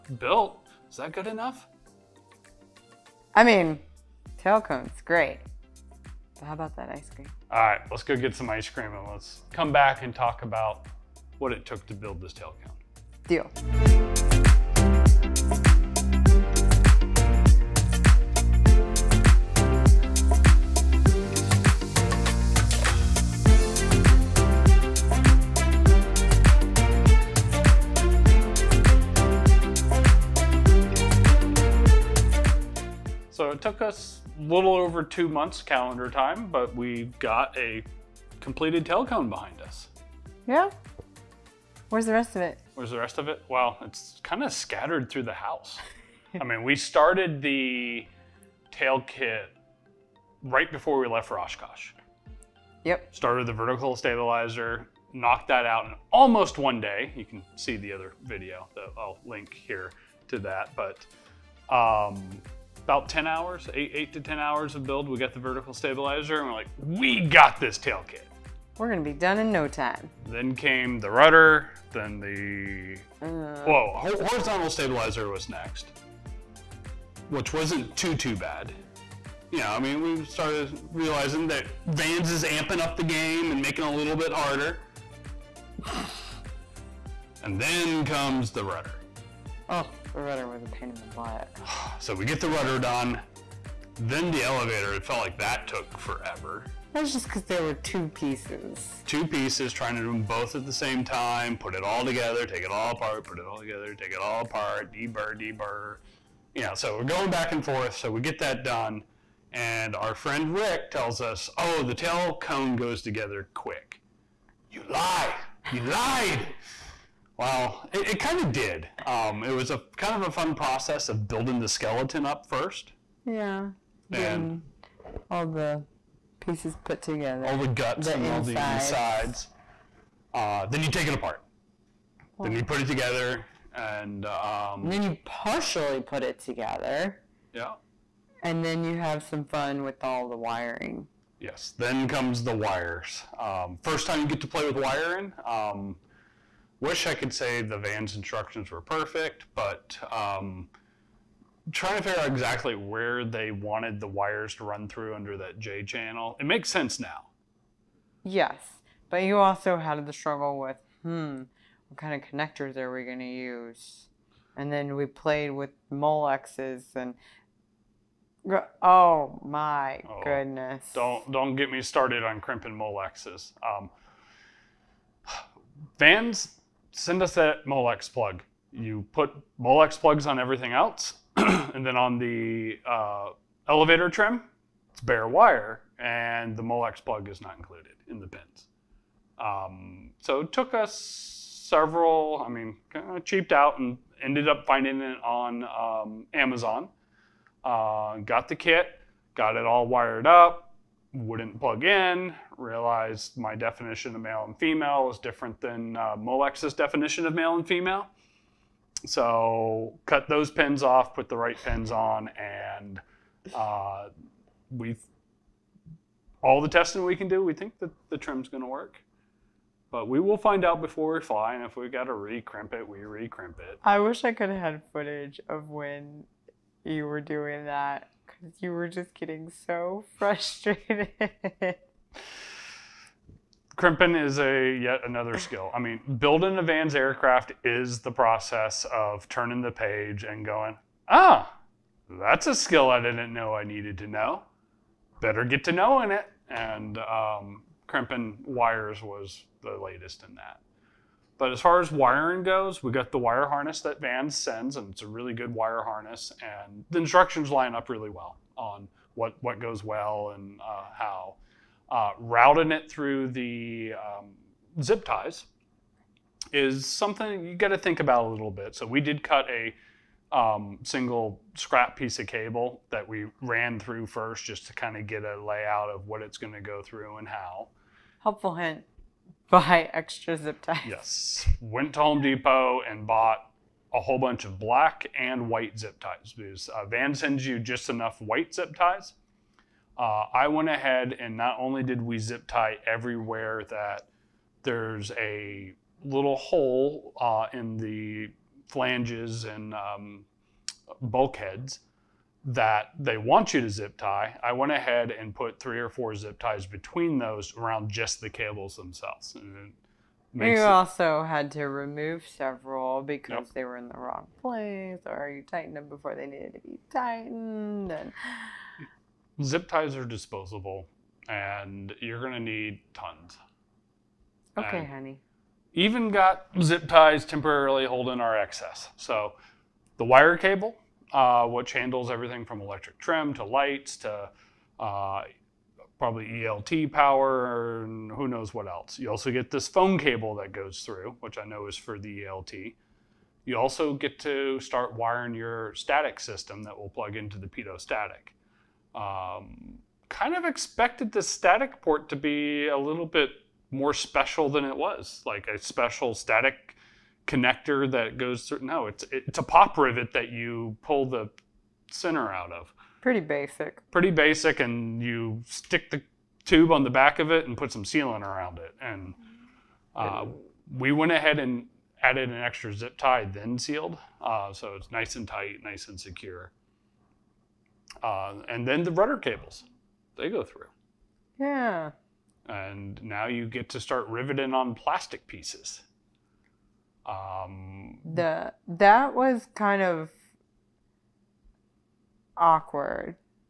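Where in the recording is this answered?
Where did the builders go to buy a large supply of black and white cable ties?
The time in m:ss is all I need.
4:41.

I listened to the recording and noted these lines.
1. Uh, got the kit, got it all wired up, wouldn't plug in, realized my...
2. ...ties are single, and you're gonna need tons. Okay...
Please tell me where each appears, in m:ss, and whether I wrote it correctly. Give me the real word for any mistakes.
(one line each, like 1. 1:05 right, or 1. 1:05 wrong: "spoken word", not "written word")
1. 3:17 right
2. 5:19 wrong: "disposable", not "single".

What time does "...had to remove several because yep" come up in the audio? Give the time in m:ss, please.
5:11.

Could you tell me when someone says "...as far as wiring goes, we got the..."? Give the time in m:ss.
4:11.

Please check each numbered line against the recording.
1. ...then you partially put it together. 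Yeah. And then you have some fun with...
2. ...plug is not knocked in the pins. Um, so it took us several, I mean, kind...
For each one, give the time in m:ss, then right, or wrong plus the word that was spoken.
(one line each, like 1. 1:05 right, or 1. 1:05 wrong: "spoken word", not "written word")
1. 2:14 right
2. 3:07 wrong: "included", not "knocked".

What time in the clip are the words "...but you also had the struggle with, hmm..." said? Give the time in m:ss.
2:39.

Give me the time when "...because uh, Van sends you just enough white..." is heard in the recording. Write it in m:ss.
4:46.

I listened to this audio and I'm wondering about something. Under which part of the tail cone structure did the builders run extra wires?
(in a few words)
J channel.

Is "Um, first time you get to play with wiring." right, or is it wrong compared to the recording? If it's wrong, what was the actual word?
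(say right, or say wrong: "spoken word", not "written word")
right.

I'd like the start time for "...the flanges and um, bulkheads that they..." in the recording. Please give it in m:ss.
4:57.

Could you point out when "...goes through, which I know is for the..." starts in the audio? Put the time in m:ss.
5:40.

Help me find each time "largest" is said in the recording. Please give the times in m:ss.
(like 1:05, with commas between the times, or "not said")
not said.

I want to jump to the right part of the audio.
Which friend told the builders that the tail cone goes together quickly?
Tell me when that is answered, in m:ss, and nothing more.
1:50.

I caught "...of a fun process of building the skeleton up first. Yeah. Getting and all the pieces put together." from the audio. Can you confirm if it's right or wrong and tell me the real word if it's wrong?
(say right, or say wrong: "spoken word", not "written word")
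right.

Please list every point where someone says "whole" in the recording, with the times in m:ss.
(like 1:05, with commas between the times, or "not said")
4:43.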